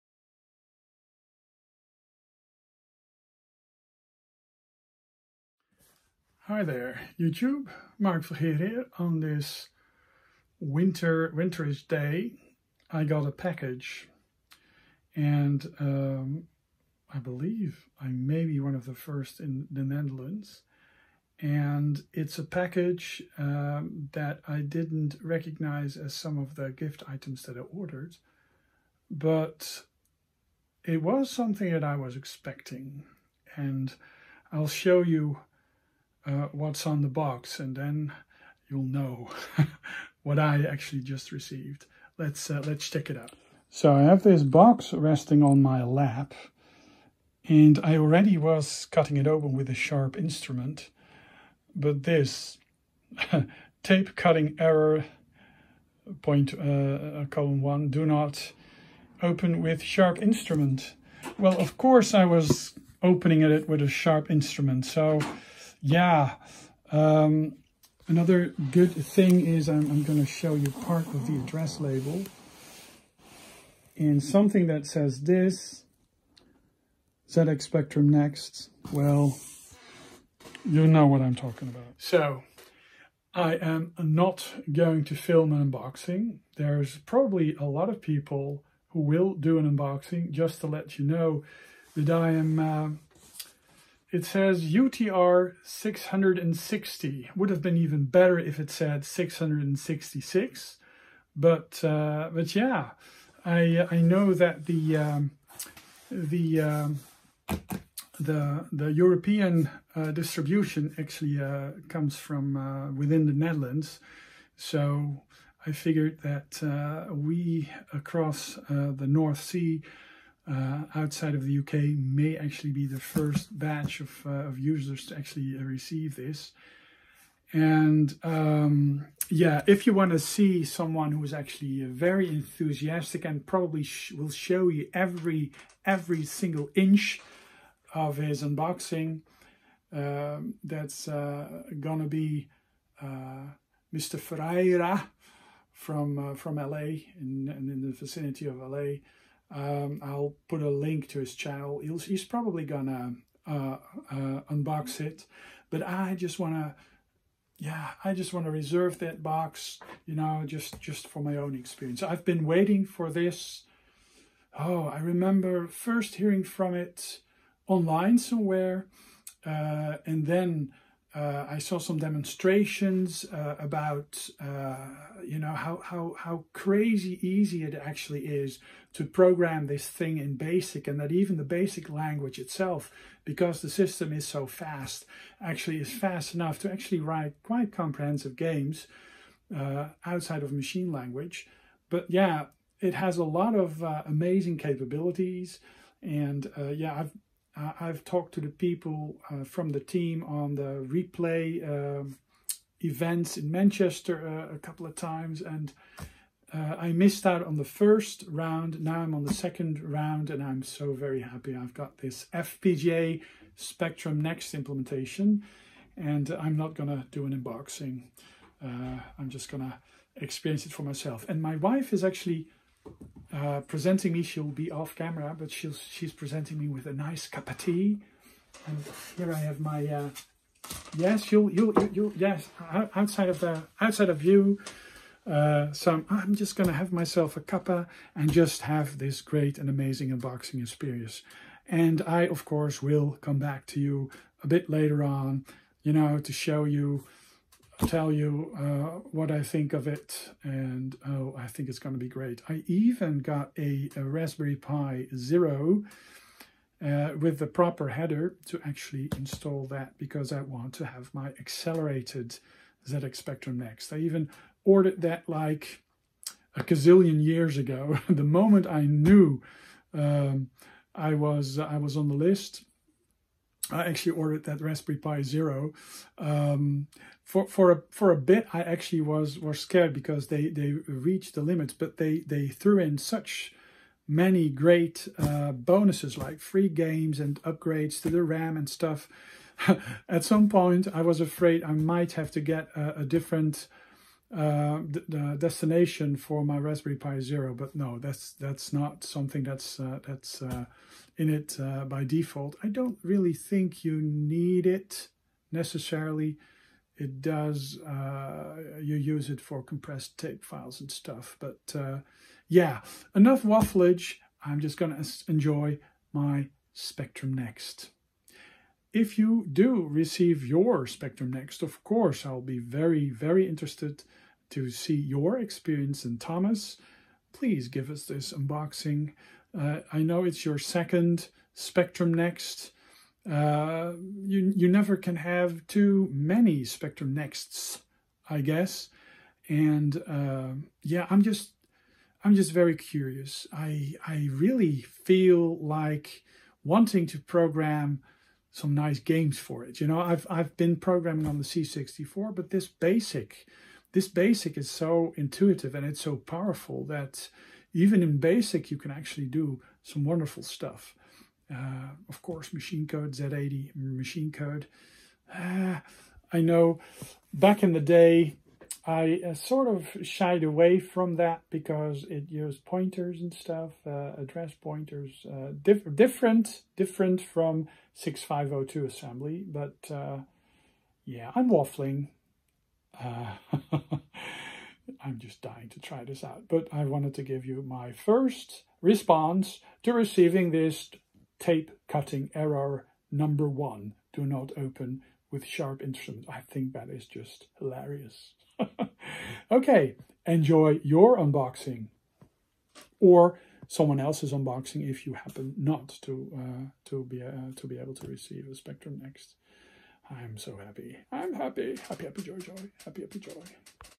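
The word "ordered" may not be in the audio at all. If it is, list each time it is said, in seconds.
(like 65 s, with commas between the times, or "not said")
27 s, 264 s, 274 s.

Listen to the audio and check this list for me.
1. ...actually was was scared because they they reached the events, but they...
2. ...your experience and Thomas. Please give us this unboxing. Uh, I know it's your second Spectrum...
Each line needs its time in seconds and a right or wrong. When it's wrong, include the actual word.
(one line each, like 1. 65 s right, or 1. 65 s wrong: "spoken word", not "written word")
1. 278 s wrong: "limits", not "events"
2. 324 s right.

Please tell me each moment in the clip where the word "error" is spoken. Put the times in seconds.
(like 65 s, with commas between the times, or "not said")
54 s, 392 s.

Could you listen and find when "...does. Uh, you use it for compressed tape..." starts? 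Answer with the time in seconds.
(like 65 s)
307 s.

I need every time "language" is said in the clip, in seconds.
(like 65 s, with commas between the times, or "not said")
181 s, 190 s.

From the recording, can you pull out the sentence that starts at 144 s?
Ferreira from from LA in, in the vicinity of LA.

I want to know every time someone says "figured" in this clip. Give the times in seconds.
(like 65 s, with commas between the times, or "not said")
115 s.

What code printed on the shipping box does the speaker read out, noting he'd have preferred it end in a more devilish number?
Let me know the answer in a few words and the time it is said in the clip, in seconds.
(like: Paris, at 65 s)
UTR 660, at 94 s.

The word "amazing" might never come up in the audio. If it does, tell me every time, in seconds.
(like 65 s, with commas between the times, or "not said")
194 s, 239 s.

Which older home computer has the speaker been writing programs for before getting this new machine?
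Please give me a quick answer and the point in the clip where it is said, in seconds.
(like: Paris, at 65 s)
C64, at 351 s.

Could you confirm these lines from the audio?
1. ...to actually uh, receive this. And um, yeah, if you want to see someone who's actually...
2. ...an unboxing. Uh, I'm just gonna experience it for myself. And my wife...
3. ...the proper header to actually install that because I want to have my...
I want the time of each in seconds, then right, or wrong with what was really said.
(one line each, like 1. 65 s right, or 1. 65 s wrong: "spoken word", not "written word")
1. 125 s right
2. 217 s right
3. 257 s right.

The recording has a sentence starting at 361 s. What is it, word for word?
Uh, of course, machine code Z80 machine code.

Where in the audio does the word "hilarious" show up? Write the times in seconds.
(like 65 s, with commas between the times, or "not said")
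397 s.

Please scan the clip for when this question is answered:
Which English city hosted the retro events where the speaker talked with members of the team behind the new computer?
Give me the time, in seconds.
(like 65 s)
203 s.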